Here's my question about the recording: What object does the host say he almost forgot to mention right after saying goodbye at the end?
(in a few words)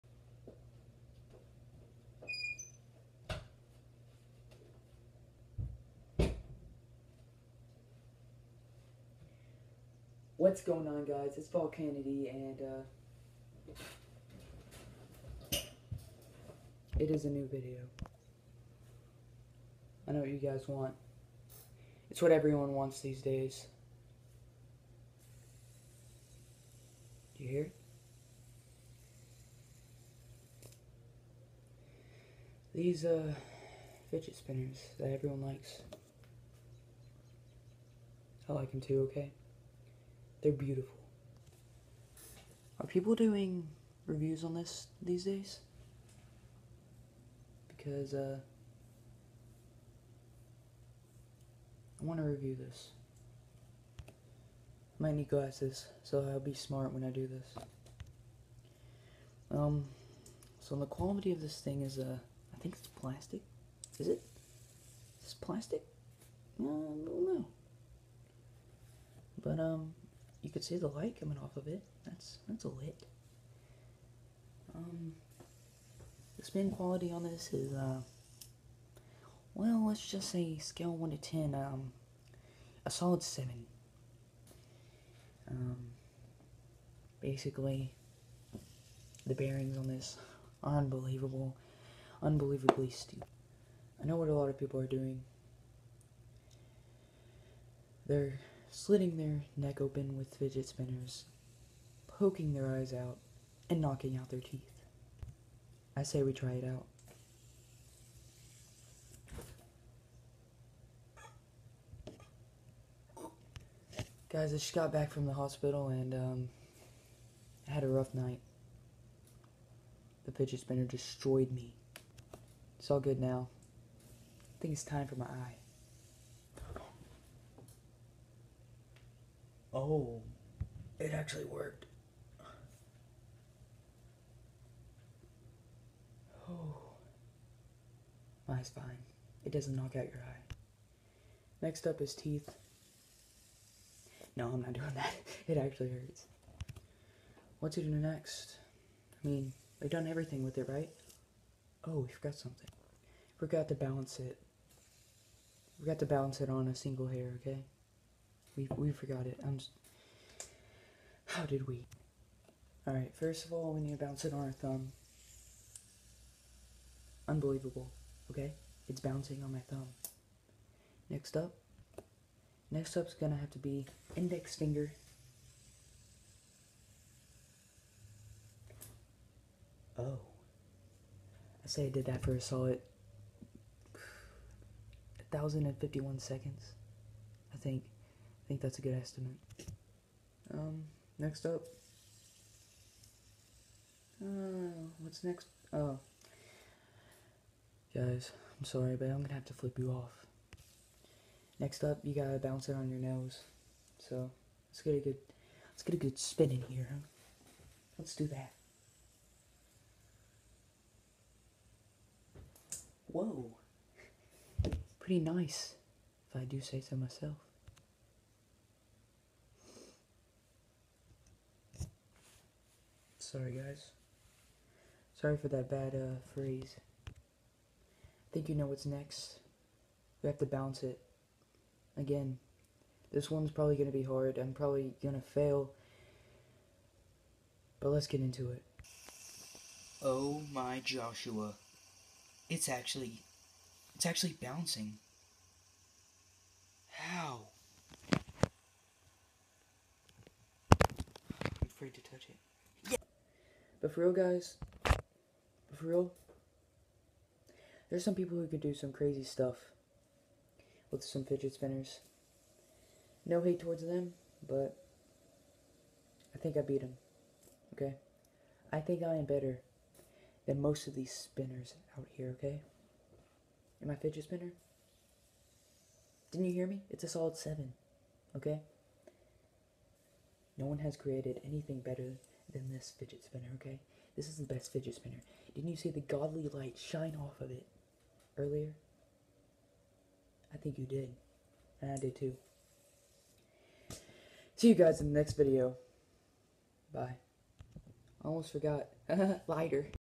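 Lighter.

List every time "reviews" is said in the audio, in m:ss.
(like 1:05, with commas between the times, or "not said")
0:44, 0:52.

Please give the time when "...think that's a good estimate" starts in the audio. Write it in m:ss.
3:08.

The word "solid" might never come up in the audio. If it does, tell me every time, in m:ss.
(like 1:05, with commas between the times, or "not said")
1:22, 3:02, 4:37.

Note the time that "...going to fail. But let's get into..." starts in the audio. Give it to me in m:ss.
3:55.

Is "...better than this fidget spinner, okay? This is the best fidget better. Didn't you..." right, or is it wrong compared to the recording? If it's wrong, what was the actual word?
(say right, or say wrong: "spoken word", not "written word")
wrong: "spinner", not "better".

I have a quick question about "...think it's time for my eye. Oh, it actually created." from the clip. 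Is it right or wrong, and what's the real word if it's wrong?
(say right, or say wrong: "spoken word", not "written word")
wrong: "worked", not "created".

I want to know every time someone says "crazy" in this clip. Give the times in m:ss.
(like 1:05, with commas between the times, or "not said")
4:18.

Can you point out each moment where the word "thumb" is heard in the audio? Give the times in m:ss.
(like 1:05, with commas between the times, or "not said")
2:44, 2:49.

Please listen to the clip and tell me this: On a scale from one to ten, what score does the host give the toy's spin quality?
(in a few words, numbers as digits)
7.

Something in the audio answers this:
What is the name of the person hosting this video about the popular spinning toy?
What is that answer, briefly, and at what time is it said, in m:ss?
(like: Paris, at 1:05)
Paul Kennedy, at 0:11.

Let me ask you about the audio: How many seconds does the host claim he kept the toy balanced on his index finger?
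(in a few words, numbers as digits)
1,051.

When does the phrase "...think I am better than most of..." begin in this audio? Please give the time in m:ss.
4:28.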